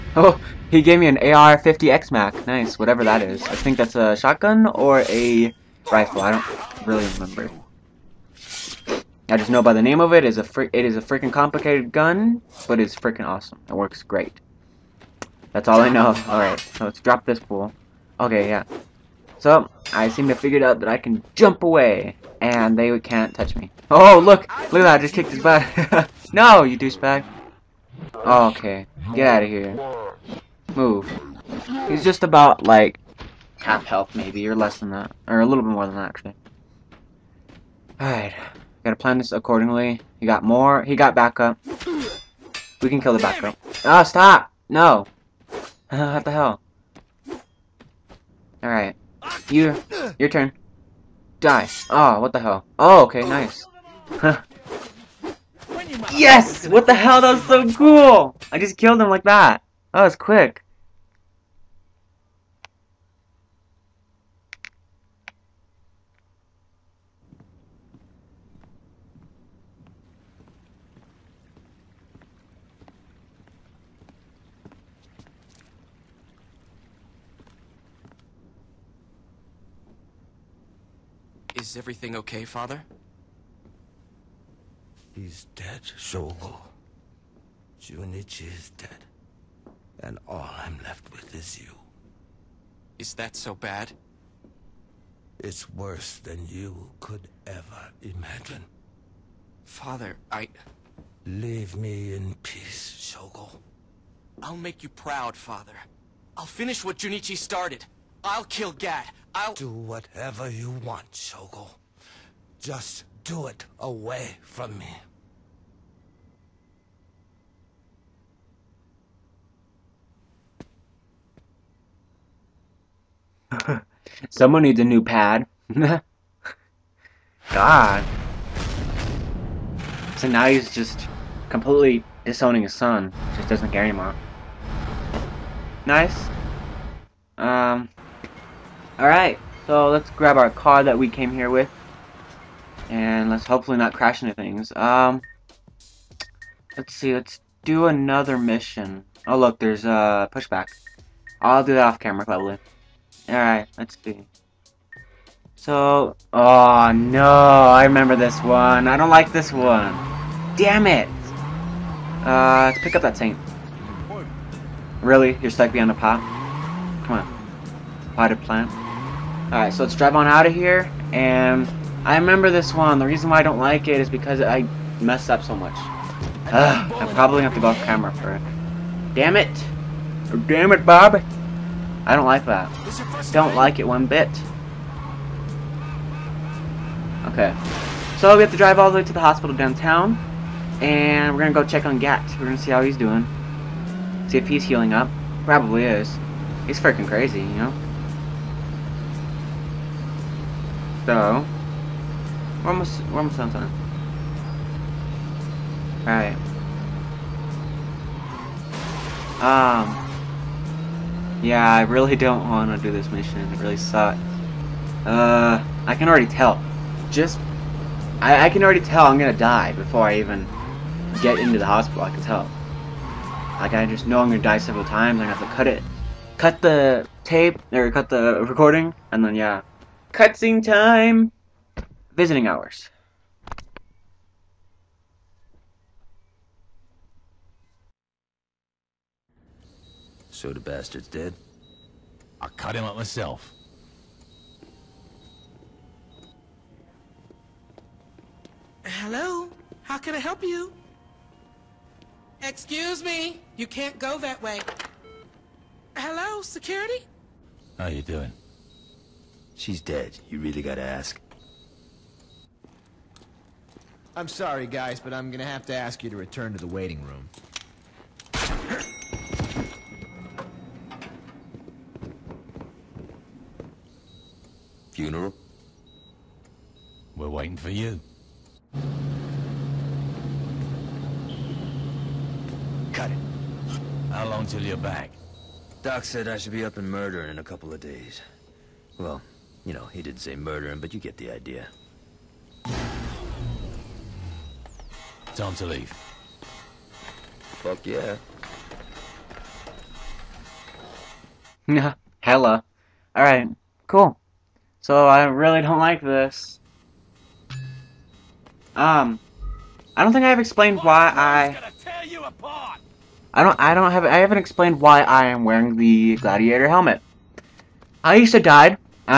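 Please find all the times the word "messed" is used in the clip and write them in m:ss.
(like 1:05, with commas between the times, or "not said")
2:54.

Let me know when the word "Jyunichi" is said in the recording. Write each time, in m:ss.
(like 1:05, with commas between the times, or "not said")
1:27, 1:46.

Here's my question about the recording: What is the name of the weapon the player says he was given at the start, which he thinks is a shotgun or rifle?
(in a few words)
AR-50X Mac.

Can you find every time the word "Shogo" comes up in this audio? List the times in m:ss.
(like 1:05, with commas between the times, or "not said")
1:25, 1:42, 1:51.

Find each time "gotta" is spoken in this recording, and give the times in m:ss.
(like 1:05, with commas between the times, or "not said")
0:38, 4:20.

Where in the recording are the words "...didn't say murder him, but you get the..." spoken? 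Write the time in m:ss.
4:50.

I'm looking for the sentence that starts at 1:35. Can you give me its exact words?
It's worse than you could ever imagine.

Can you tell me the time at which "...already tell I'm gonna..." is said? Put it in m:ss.
3:38.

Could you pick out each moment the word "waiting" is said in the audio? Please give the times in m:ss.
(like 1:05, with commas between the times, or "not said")
4:26, 4:37.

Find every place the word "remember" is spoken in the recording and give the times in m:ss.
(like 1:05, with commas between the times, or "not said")
0:07, 2:37, 2:52.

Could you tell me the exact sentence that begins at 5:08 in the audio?
Um, I don't think I've explained why I...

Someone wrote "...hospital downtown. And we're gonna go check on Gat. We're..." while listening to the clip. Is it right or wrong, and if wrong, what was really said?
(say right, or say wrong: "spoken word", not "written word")
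right.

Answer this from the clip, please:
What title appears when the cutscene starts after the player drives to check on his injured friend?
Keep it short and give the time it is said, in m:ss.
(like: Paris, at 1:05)
Visiting hours, at 3:52.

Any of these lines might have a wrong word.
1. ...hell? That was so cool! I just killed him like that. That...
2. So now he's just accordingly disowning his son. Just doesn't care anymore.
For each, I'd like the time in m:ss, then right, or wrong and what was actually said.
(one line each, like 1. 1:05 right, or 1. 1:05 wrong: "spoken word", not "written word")
1. 0:56 right
2. 2:10 wrong: "completely", not "accordingly".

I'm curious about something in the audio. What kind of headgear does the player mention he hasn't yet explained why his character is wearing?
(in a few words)
gladiator helmet.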